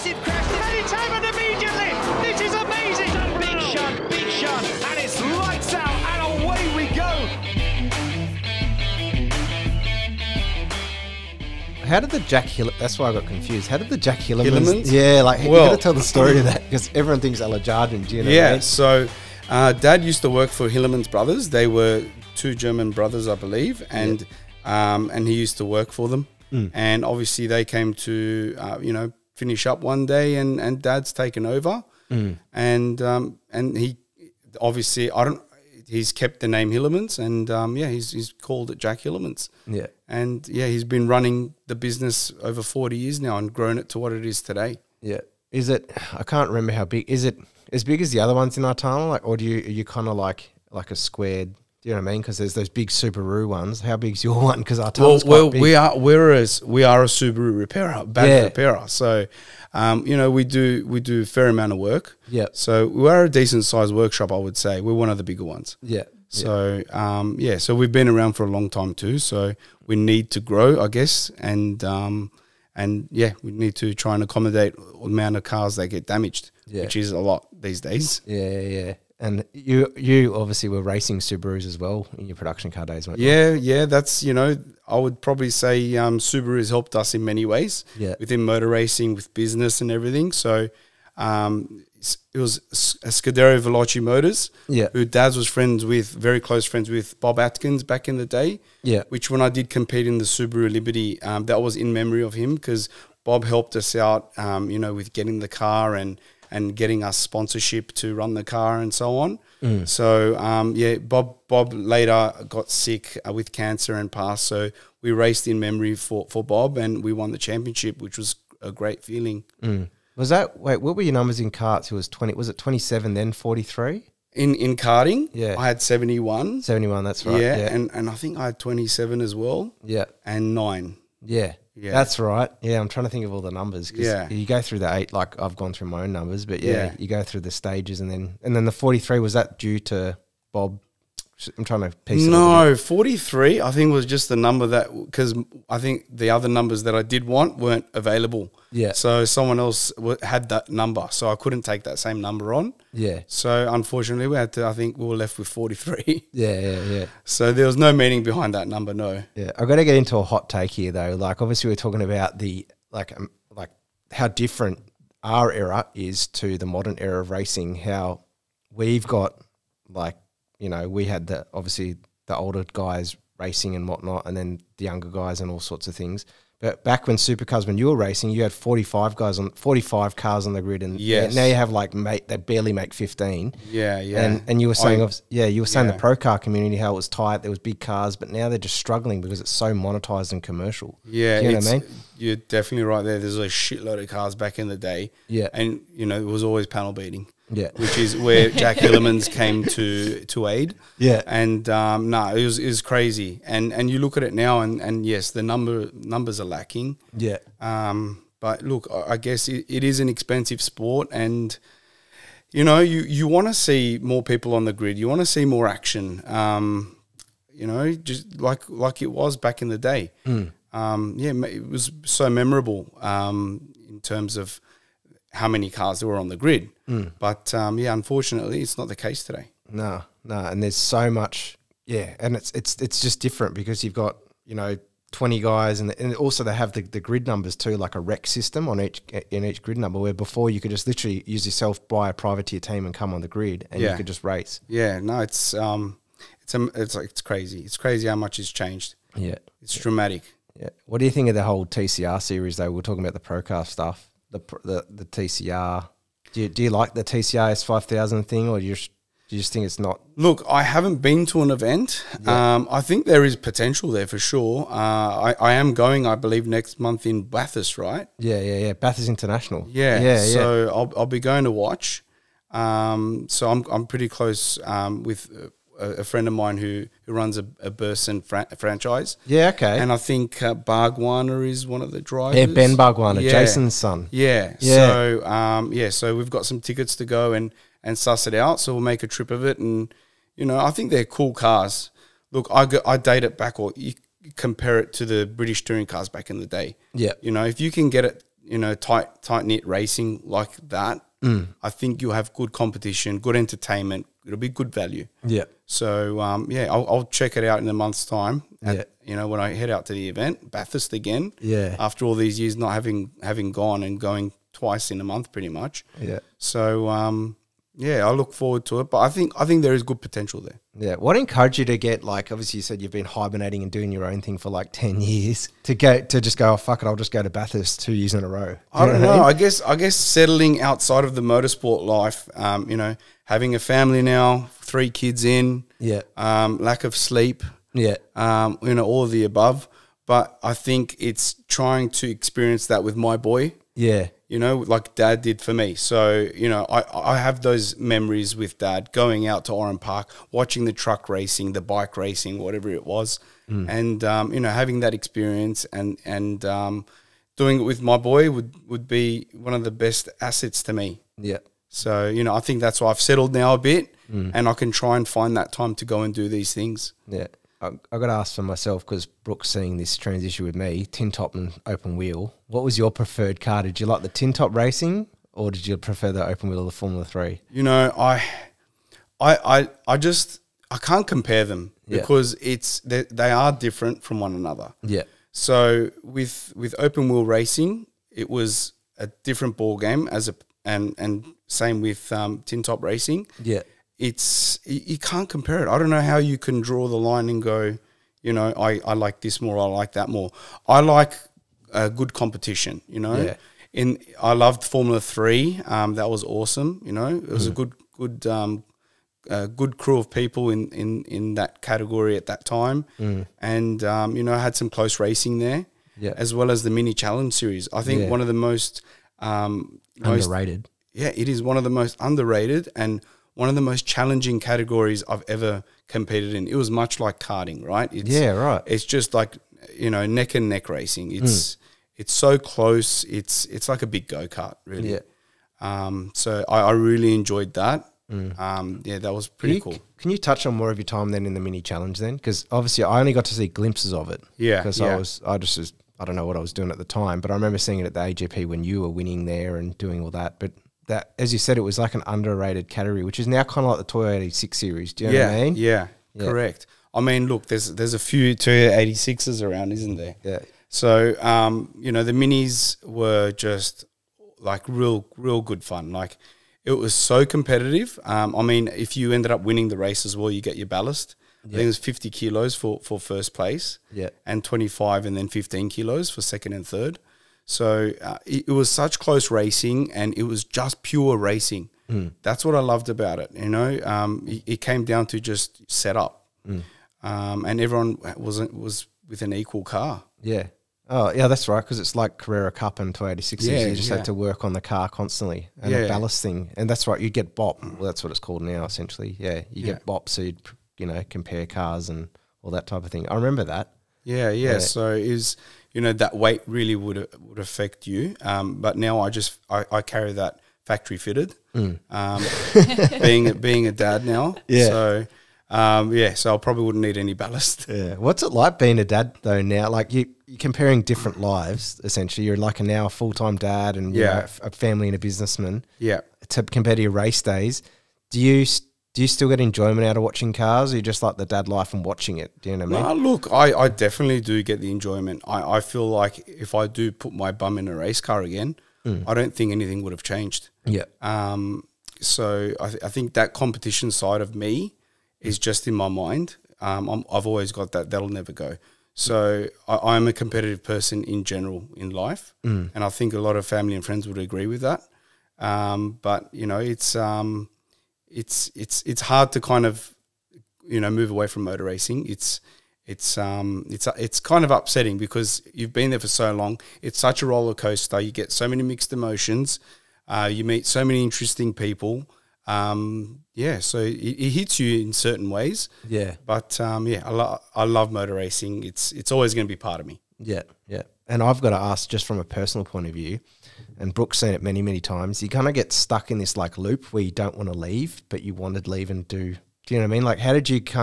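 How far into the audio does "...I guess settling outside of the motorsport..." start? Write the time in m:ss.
5:29.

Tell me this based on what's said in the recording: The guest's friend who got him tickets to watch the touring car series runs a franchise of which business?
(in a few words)
Burson.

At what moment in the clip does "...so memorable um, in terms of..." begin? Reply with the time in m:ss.
3:42.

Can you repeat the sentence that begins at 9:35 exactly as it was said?
Yeah, but um, yeah, I, lo I love motor racing.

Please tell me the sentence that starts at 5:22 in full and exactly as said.
Obviously, you said you've been hibernating and doing your own thing for like ten years.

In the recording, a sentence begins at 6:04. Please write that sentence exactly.
and I can try and find that time to go and do these things.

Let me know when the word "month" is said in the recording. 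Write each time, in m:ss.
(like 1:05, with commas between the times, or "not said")
4:26, 5:07, 5:15.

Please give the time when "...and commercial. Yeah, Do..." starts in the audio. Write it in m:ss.
3:10.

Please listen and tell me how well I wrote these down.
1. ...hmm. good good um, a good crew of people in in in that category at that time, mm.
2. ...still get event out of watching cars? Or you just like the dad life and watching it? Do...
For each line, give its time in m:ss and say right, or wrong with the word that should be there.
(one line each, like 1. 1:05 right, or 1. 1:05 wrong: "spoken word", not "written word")
1. 6:47 right
2. 8:49 wrong: "enjoyment", not "event".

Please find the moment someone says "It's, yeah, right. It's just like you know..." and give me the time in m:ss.
7:07.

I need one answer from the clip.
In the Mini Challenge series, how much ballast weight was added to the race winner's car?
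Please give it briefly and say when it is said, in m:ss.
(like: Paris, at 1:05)
50 kilos, at 7:51.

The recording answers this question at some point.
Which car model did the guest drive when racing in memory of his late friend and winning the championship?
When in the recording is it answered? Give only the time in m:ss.
1:40.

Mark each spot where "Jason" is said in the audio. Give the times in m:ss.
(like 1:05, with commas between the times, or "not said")
4:43.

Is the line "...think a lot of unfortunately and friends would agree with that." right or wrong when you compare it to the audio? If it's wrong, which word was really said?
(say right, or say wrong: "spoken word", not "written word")
wrong: "family", not "unfortunately".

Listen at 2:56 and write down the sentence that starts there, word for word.
But back when supercars, when you were racing, you had forty five guys on forty five cars on the grid, and yes.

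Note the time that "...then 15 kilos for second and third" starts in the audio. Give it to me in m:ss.
7:55.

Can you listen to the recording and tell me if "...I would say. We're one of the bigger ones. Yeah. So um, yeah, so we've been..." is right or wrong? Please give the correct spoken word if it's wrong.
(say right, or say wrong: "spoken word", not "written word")
right.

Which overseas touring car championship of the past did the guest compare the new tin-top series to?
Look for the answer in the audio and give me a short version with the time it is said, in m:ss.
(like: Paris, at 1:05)
British touring cars, at 4:55.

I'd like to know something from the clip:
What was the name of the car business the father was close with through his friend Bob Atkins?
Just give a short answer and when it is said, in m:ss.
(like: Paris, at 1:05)
Scuderia Veloce Motors, at 1:33.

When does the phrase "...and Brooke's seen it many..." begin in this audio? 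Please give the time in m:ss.
9:43.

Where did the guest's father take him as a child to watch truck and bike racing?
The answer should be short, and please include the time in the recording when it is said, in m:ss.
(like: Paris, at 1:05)
Oran Park, at 5:49.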